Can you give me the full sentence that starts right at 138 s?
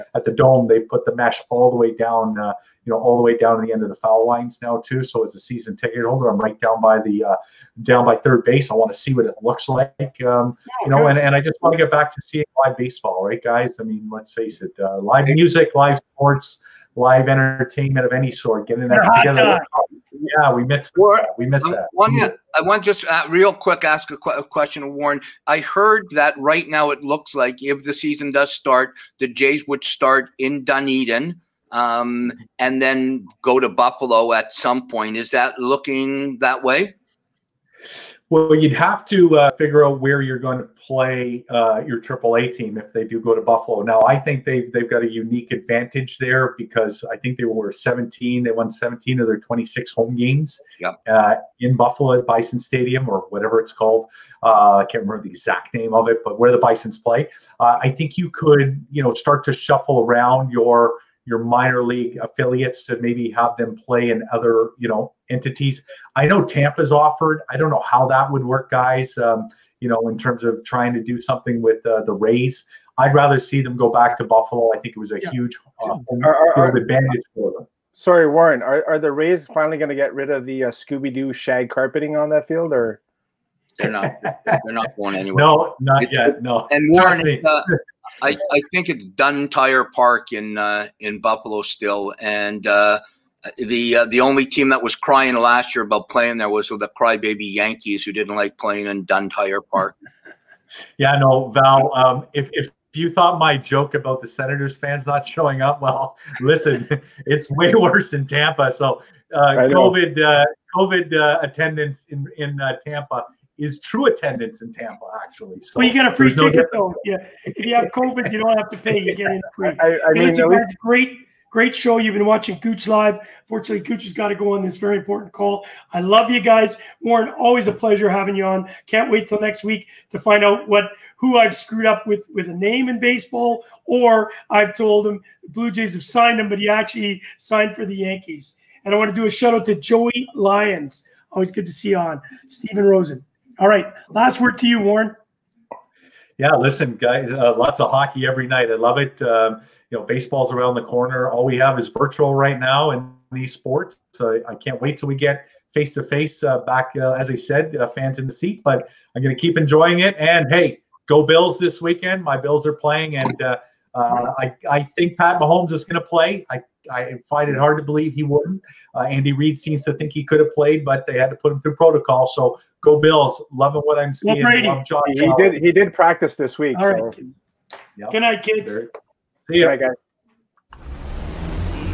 And I want to do a shout out to Joey Lyons.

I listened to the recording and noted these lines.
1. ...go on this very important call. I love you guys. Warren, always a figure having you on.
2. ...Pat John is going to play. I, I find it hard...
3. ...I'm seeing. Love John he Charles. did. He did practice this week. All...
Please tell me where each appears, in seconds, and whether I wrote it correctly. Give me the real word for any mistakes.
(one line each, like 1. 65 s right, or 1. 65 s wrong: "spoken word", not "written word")
1. 124 s wrong: "pleasure", not "figure"
2. 165 s wrong: "Mahomes", not "John"
3. 173 s right.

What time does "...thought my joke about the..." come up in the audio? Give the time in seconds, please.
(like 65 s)
103 s.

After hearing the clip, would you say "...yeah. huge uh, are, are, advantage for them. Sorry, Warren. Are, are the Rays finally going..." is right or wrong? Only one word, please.
right.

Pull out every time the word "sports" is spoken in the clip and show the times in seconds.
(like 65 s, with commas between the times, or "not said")
16 s, 153 s.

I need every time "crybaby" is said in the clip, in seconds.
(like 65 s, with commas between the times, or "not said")
96 s.